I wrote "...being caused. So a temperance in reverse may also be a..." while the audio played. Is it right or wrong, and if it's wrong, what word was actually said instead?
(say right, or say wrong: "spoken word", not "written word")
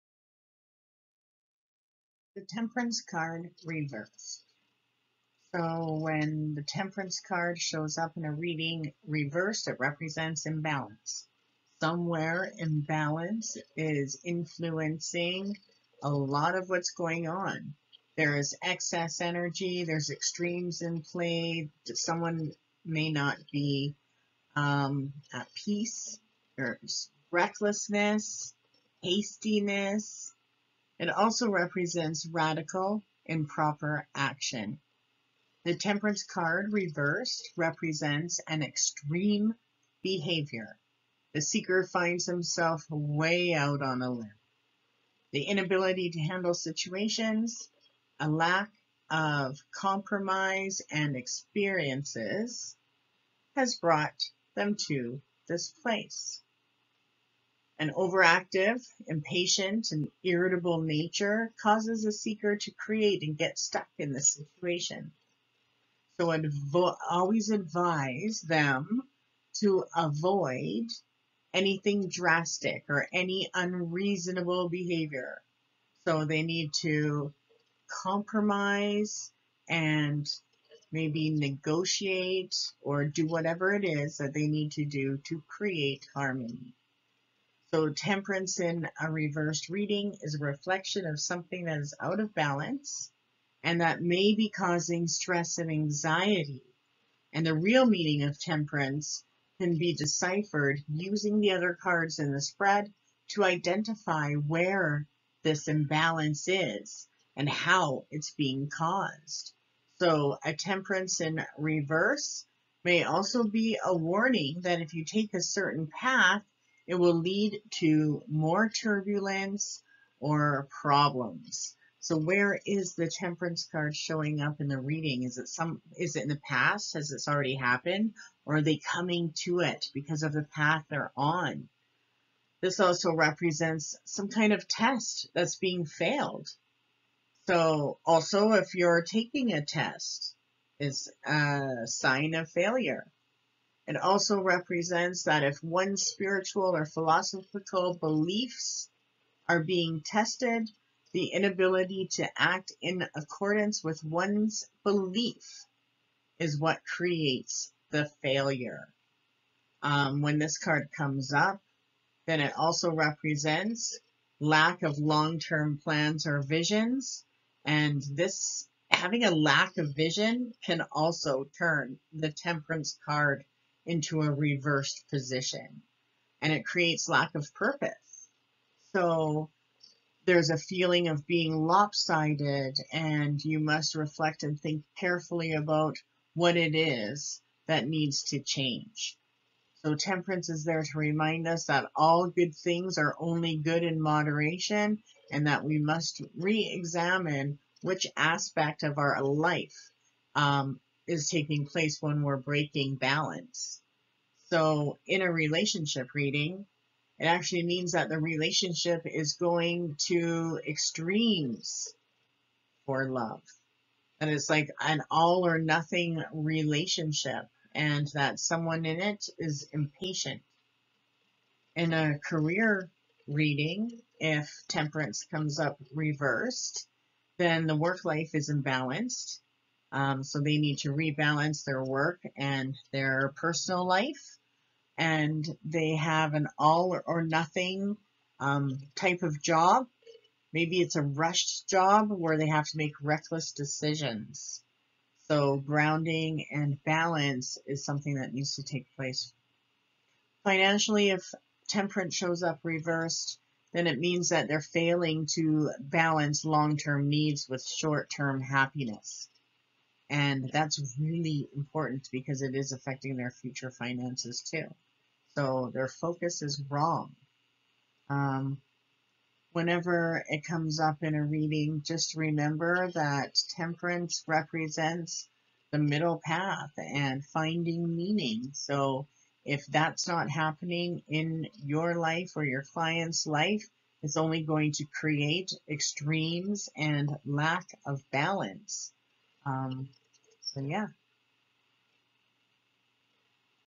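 right.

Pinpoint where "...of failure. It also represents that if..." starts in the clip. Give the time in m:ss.
2:22.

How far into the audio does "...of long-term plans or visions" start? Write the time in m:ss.
2:44.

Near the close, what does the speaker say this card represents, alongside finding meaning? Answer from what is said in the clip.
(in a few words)
the middle path.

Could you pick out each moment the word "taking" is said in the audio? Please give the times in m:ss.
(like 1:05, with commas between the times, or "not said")
2:19, 3:21.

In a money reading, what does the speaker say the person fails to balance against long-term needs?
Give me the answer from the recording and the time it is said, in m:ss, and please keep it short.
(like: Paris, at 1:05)
short-term happiness, at 4:17.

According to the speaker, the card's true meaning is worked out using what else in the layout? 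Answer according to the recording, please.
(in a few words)
other cards in the spread.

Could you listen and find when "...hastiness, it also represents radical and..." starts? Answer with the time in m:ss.
0:29.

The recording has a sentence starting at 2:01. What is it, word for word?
So where is the temperance card showing up in the reading?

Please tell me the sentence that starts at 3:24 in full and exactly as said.
So in a relationship reading, it actually means that the relationship is going to extremes for love.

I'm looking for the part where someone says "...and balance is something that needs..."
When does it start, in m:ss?
4:06.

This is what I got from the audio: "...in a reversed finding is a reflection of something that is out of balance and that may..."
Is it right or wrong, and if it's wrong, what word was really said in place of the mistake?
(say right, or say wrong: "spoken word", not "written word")
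wrong: "reading", not "finding".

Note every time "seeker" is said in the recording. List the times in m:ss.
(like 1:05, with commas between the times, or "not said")
0:41, 1:02.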